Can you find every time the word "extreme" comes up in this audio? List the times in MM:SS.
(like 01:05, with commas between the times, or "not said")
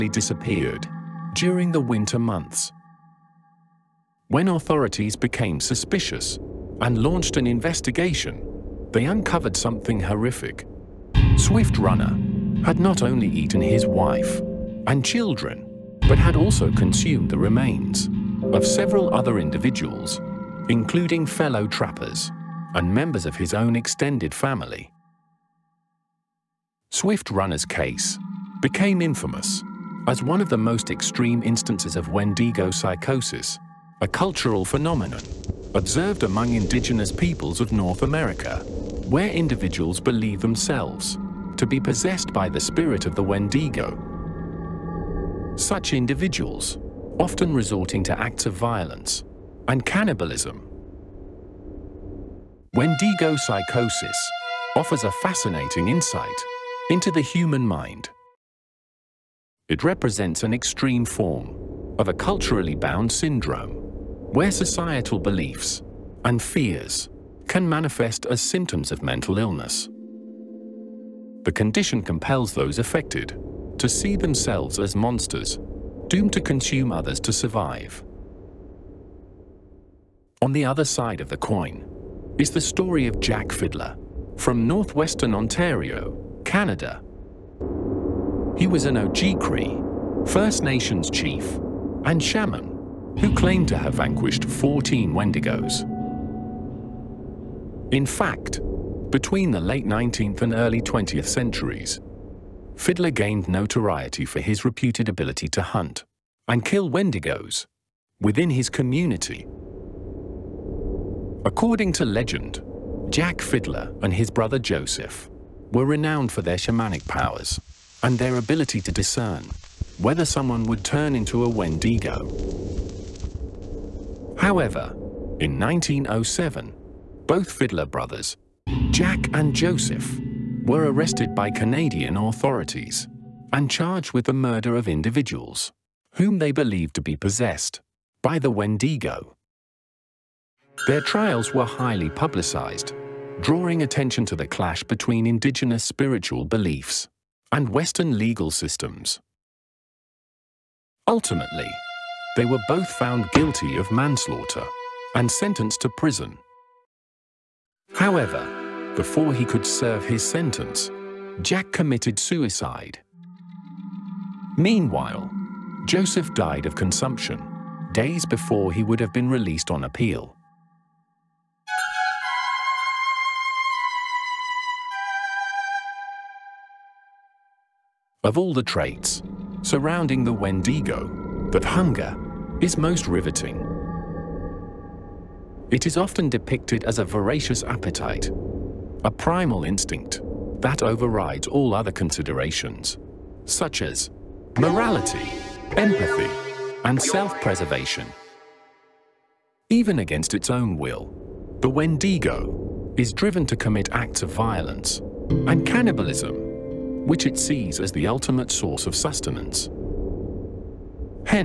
00:30, 01:00.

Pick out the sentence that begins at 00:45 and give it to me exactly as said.
Such individuals, often resorting to acts of violence and cannibalism.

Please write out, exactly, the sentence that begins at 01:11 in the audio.
The condition compels those affected to see themselves as monsters, doomed to consume others to survive.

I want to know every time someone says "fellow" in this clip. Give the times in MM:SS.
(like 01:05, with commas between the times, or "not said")
00:21.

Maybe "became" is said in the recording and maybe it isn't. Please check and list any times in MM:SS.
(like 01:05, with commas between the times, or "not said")
00:05, 00:28.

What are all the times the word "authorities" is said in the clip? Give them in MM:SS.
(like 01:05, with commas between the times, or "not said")
00:04, 02:12.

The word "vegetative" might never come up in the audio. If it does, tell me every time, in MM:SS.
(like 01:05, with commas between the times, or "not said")
not said.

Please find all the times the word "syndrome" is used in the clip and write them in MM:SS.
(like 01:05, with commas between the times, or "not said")
01:03.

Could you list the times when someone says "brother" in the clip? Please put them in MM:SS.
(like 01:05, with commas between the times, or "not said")
01:54, 02:07.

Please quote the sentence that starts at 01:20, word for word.
On the other side of the coin is the story of Jack Fiddler from northwestern Ontario, Canada.